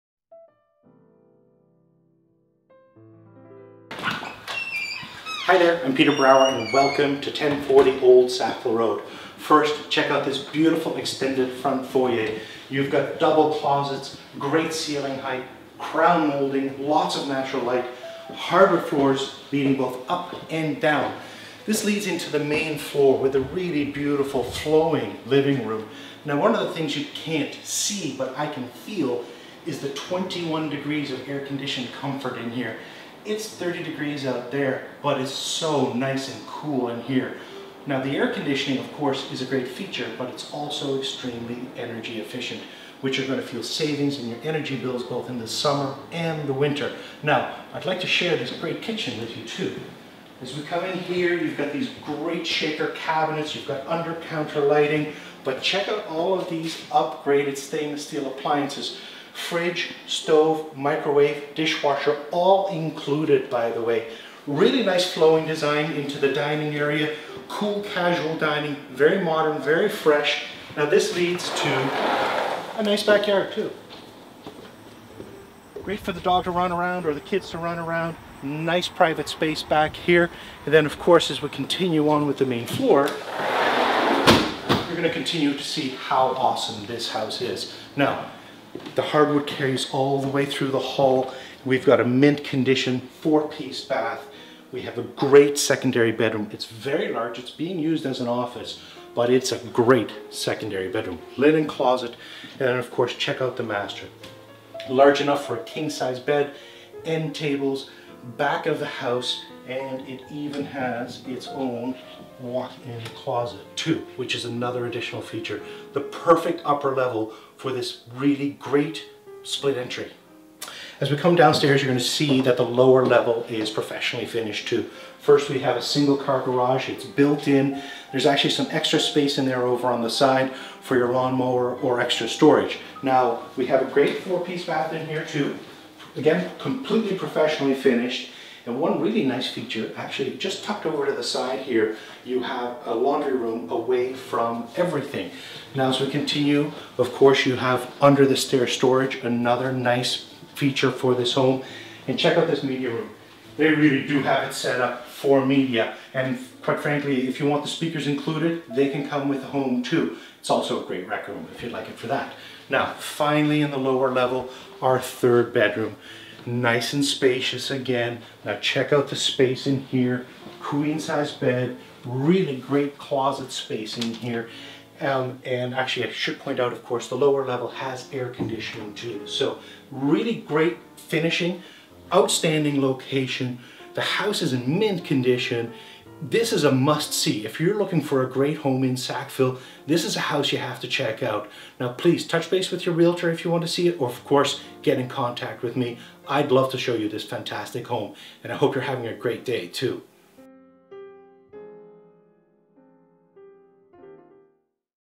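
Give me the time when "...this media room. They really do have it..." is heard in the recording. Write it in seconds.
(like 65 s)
152 s.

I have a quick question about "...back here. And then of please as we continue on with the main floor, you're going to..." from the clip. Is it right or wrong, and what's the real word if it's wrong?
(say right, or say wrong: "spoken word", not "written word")
wrong: "course", not "please".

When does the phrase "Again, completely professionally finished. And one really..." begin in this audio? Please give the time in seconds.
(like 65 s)
136 s.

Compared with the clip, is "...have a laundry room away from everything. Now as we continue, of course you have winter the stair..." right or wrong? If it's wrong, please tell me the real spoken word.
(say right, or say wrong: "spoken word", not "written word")
wrong: "under", not "winter".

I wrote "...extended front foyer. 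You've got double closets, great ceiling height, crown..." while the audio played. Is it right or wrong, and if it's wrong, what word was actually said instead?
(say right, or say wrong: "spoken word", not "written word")
right.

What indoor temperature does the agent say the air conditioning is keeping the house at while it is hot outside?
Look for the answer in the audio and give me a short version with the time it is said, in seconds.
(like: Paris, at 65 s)
21 degrees, at 29 s.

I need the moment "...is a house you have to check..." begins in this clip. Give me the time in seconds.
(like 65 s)
190 s.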